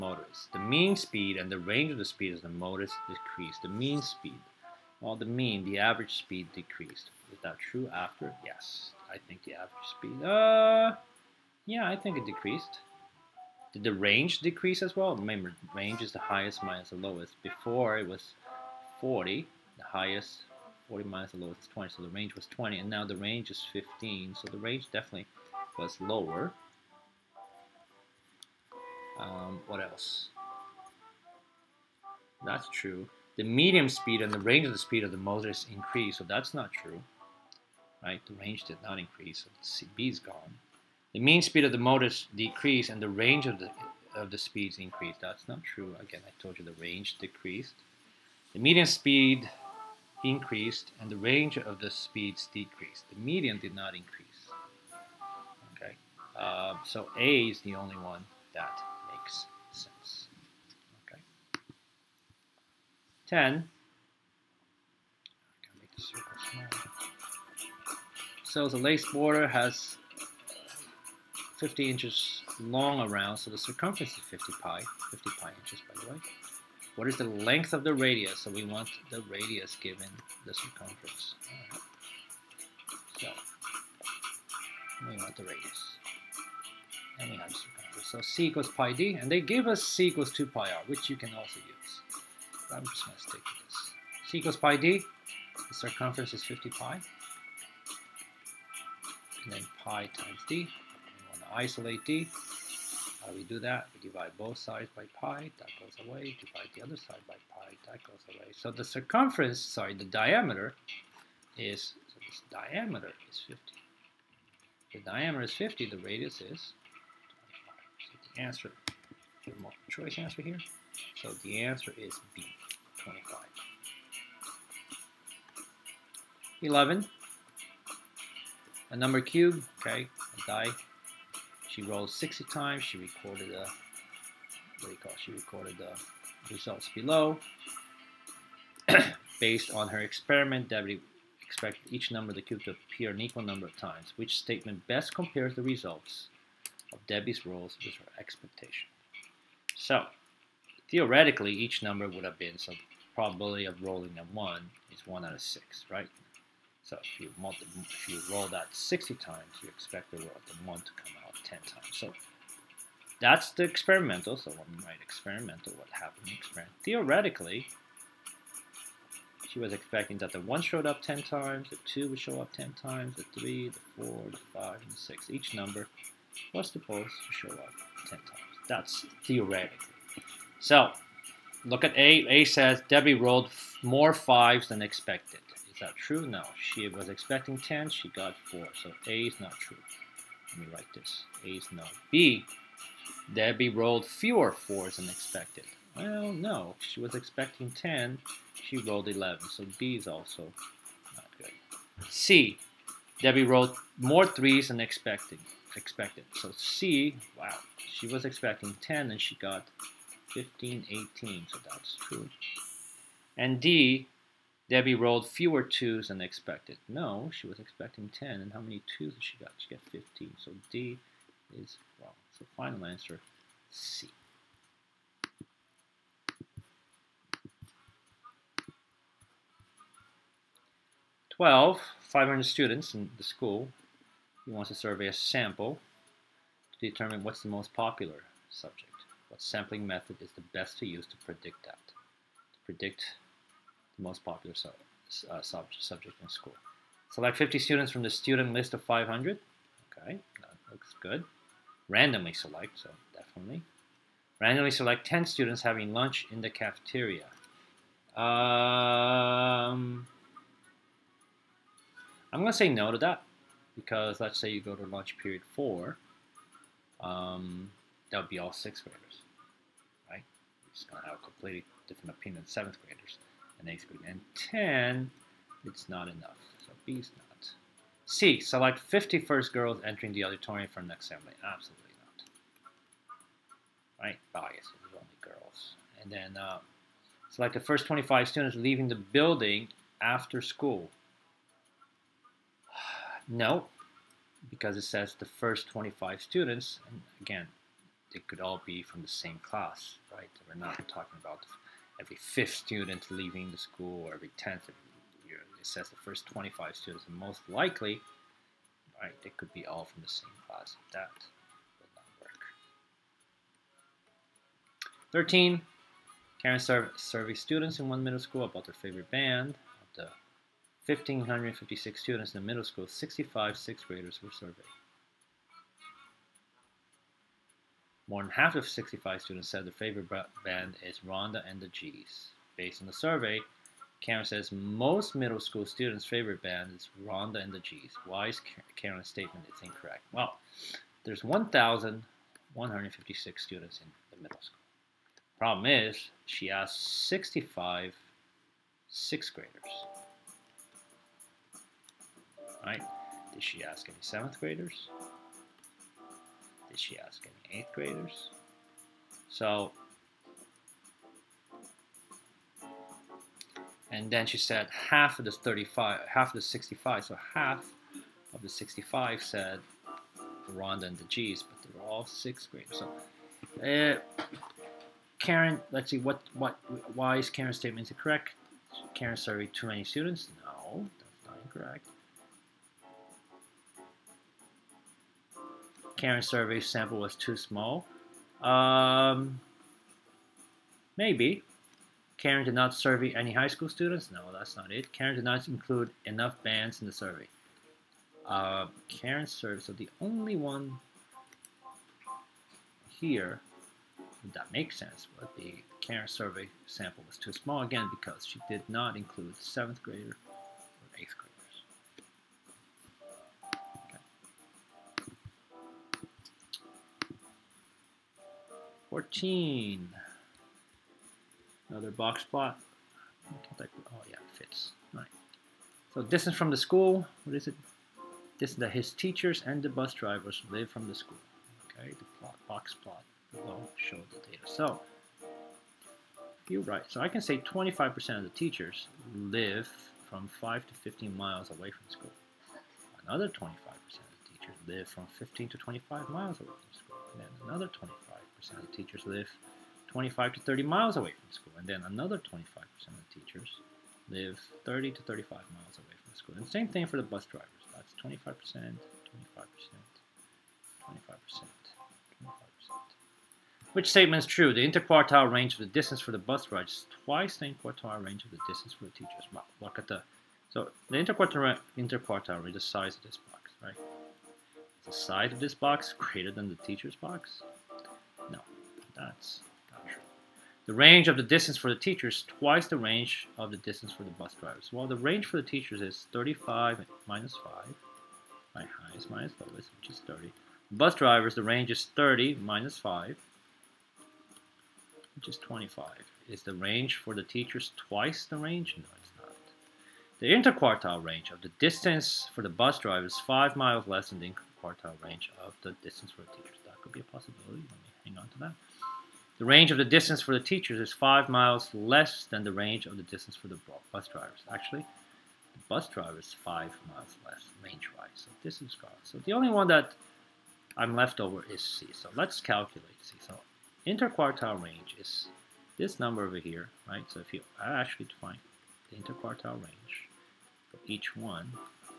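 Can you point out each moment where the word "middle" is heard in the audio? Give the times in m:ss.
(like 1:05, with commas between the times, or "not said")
5:18, 5:22, 5:35, 5:44.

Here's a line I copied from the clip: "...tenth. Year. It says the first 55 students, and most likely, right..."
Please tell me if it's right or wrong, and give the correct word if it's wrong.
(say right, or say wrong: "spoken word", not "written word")
wrong: "25", not "55".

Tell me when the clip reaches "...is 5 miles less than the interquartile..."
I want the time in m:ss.
8:23.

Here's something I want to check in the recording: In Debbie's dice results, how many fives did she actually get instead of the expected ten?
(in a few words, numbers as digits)
4.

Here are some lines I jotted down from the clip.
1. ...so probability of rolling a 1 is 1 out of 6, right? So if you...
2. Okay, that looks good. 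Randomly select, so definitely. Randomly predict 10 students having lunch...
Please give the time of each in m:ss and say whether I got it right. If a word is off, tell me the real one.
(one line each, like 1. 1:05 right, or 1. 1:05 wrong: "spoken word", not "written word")
1. 2:32 right
2. 4:09 wrong: "select", not "predict".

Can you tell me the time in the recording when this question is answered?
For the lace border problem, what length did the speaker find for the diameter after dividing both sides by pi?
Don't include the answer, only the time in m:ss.
1:52.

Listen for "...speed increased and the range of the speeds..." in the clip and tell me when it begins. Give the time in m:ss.
0:48.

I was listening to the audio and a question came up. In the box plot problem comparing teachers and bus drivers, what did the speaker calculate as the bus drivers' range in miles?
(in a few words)
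25.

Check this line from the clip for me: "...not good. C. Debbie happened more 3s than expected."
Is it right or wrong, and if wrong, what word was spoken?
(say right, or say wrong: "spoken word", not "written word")
wrong: "rolled", not "happened".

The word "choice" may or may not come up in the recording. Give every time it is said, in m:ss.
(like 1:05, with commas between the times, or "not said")
1:59.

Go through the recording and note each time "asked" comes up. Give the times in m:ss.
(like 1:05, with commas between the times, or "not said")
5:46.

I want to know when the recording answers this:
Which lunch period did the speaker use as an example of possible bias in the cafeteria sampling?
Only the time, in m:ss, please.
4:24.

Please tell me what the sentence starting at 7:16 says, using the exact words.
So I can say 25% of the teachers live from 5 to 15 miles away from school.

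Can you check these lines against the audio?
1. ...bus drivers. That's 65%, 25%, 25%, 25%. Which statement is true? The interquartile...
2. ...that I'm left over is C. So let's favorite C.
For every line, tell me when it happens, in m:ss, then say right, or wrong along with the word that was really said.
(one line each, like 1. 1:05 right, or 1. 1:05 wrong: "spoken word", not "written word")
1. 7:37 wrong: "25", not "65"
2. 8:39 wrong: "calculate", not "favorite".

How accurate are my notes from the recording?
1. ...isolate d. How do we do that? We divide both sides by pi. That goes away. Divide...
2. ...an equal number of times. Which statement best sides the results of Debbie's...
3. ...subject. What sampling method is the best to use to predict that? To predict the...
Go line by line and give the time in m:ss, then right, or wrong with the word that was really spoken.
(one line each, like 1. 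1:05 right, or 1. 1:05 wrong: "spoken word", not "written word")
1. 1:41 right
2. 2:23 wrong: "compares", not "sides"
3. 3:58 right.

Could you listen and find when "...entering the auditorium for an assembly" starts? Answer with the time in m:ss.
4:39.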